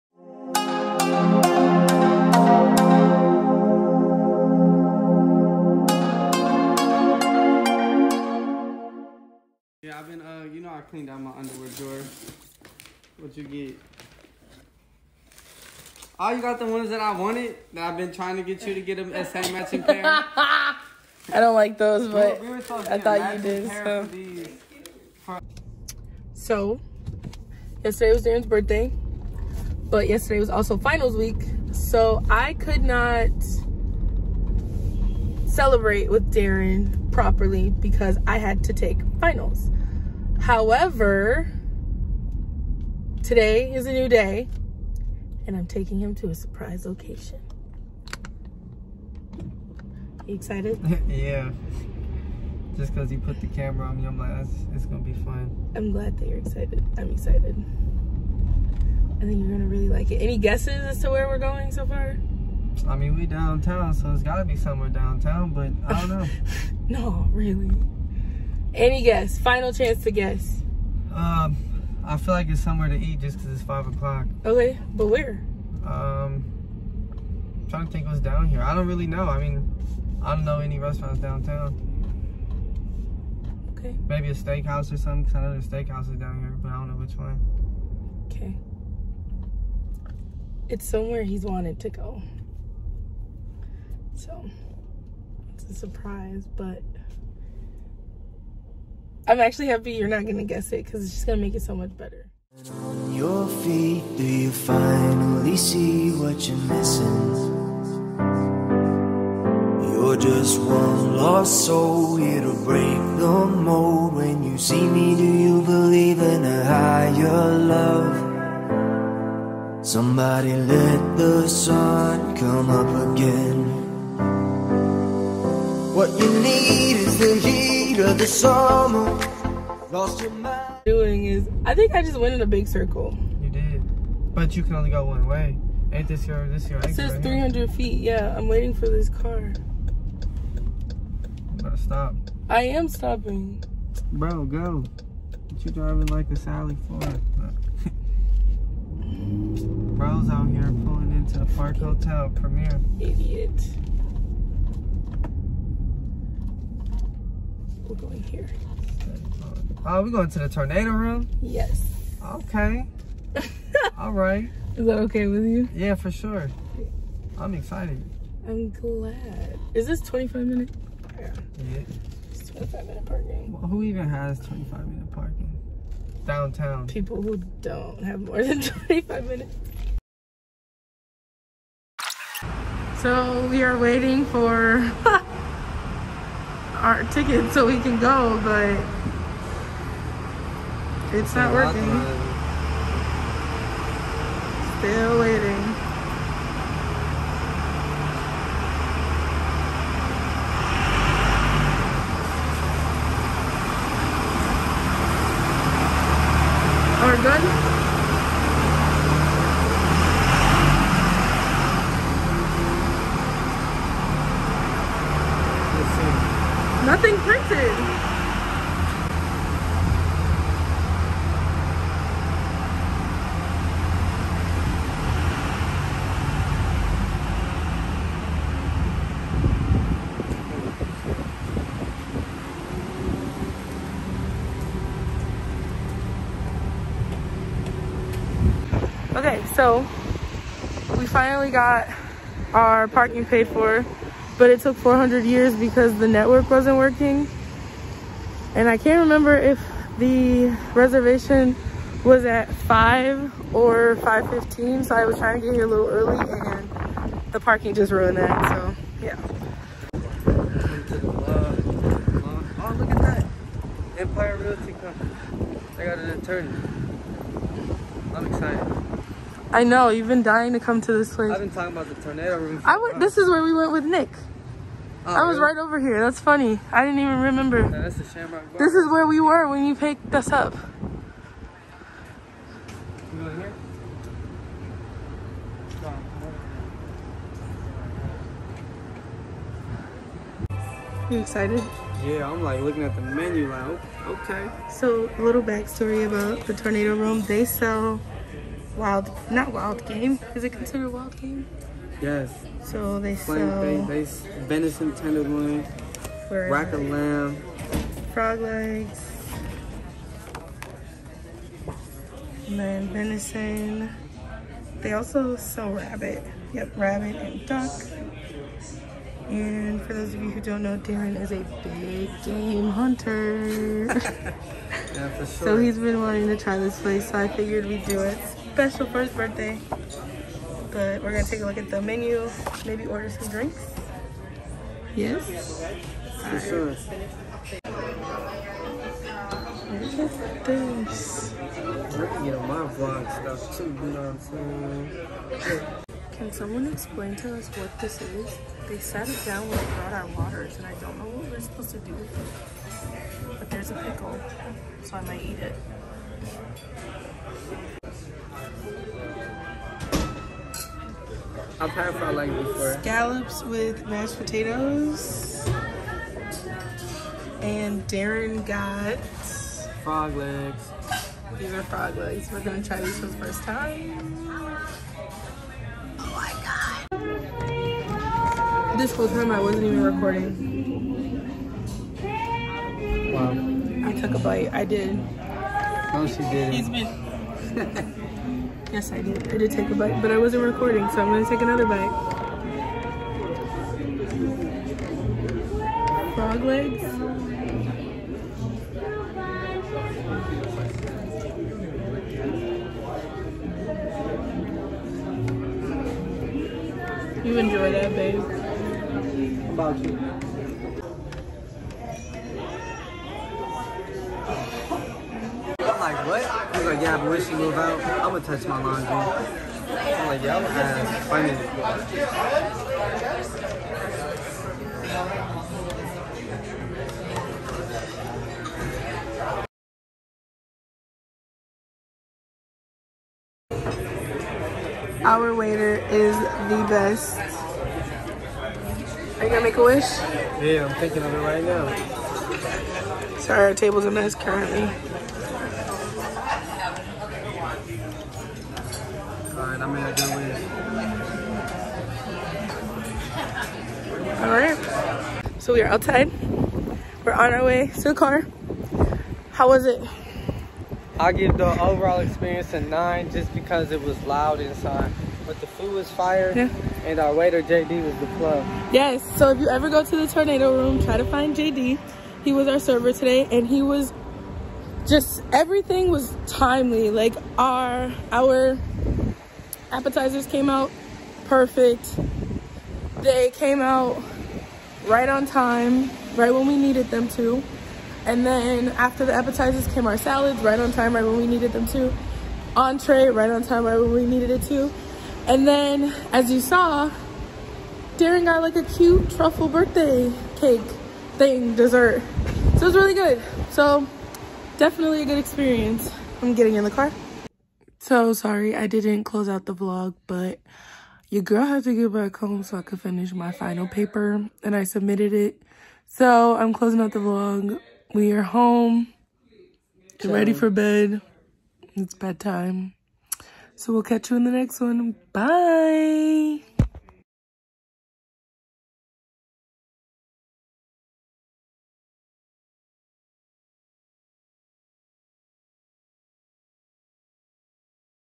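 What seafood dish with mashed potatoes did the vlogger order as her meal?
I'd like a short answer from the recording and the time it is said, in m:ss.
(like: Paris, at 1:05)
Scallops, at 6:02.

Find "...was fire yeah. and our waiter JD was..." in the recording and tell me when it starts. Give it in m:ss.
7:45.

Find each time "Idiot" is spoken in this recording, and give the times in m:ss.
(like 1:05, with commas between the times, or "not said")
2:32.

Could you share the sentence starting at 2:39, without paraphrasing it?
Oh, we're going to the tornado room?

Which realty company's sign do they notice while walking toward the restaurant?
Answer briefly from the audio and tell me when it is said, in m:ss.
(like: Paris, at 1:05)
Empire Realty Company, at 4:23.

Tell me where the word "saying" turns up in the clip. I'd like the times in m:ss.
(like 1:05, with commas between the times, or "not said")
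5:45.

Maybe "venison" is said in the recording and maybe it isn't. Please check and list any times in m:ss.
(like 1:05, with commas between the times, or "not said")
5:04, 5:12.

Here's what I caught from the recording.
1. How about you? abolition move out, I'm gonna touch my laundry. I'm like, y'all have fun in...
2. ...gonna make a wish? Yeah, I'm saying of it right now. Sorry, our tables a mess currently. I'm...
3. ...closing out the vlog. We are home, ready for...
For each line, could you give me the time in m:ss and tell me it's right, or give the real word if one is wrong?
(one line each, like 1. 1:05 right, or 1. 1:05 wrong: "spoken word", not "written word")
1. 6:48 right
2. 7:19 wrong: "thinking", not "saying"
3. 8:36 right.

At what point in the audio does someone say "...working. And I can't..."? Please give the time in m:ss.
4:06.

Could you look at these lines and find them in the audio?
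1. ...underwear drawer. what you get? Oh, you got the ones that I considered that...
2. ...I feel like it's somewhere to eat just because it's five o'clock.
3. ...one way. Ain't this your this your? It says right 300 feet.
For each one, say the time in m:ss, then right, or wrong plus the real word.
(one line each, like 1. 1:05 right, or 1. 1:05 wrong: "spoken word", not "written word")
1. 0:11 wrong: "wanted", not "considered"
2. 1:12 right
3. 2:15 right.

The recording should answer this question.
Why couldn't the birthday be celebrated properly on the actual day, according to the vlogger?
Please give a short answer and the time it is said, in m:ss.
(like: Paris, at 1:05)
Finals week, at 0:30.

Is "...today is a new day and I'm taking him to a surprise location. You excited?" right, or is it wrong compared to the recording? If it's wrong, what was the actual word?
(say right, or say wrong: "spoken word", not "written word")
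right.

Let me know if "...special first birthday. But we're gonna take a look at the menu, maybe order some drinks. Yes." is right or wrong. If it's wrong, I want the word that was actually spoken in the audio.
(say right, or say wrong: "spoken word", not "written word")
right.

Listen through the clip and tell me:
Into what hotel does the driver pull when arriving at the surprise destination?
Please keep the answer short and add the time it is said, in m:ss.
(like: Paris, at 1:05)
Park Hotel Premier, at 2:31.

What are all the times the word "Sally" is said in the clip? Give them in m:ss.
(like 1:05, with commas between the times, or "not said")
2:26.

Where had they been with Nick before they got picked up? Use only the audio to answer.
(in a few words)
Shamrock Bar.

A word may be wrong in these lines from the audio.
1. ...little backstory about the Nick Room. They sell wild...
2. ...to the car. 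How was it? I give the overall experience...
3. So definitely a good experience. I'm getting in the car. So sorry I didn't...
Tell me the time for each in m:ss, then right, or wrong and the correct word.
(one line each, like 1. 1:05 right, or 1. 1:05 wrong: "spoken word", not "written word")
1. 4:55 wrong: "Tornado", not "Nick"
2. 7:37 right
3. 8:23 right.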